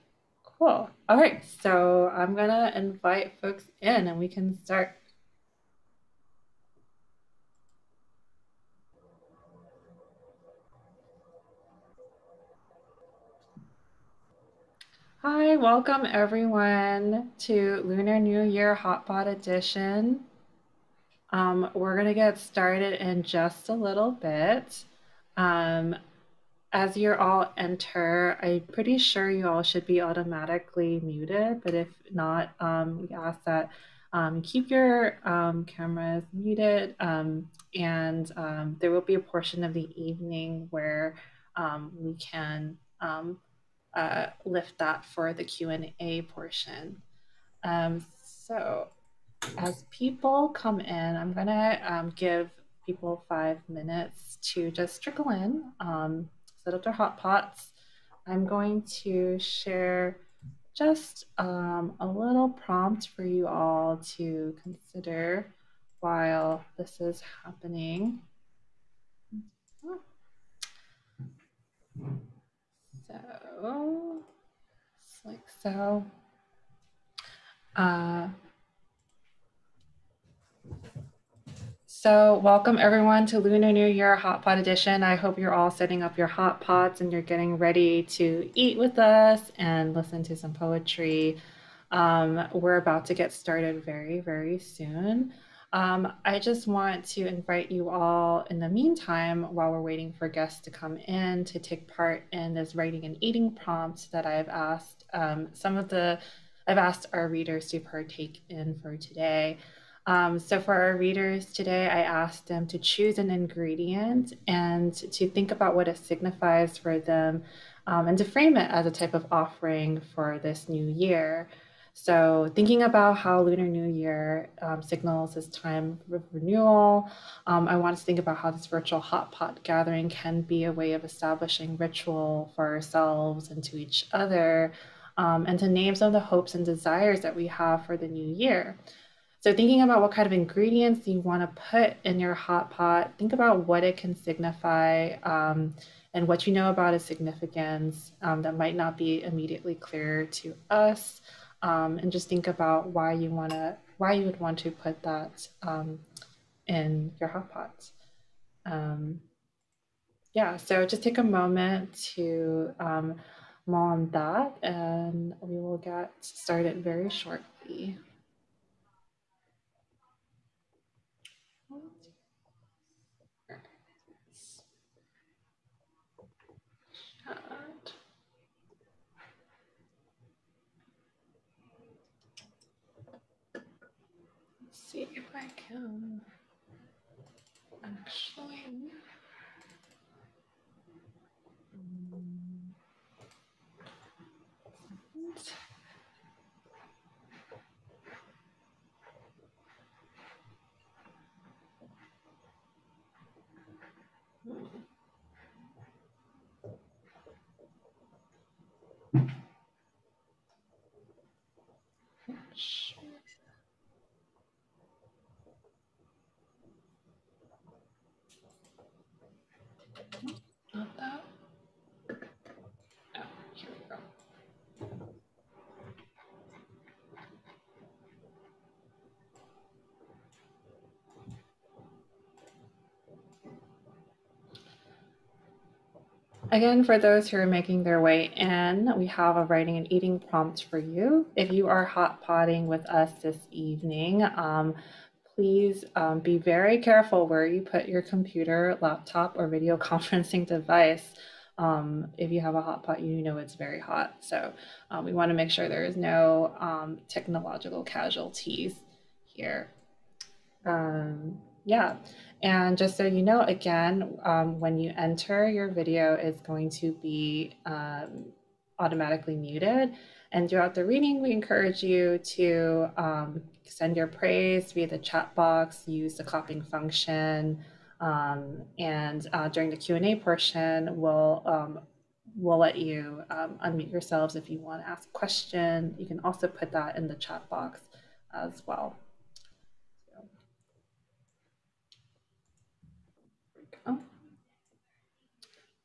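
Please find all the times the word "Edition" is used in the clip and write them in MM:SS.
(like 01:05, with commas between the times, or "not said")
00:19, 01:24.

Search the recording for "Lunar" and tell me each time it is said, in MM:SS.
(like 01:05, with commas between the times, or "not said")
00:17, 01:23, 02:03.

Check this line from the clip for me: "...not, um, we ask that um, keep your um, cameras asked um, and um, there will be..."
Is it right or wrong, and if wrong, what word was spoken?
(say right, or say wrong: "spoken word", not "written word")
wrong: "muted", not "asked".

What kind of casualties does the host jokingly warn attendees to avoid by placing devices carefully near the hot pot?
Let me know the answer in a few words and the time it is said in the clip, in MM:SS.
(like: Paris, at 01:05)
Technological casualties, at 04:17.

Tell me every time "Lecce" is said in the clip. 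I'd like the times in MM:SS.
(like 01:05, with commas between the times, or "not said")
not said.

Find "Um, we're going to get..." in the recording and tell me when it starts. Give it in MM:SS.
00:21.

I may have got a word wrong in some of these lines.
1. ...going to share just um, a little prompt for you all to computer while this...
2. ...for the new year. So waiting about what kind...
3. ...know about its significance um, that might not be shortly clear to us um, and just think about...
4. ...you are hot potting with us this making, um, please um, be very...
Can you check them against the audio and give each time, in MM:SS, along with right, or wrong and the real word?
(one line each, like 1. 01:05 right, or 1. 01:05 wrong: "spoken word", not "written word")
1. 00:58 wrong: "consider", not "computer"
2. 02:17 wrong: "thinking", not "waiting"
3. 02:26 wrong: "immediately", not "shortly"
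4. 04:01 wrong: "evening", not "making".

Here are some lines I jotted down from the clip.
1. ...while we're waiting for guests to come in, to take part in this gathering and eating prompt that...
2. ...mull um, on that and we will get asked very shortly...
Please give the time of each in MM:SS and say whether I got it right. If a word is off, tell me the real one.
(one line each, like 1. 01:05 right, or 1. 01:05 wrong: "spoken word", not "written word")
1. 01:39 wrong: "writing", not "gathering"
2. 02:42 wrong: "started", not "asked".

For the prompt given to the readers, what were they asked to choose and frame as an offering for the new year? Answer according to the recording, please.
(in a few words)
An ingredient.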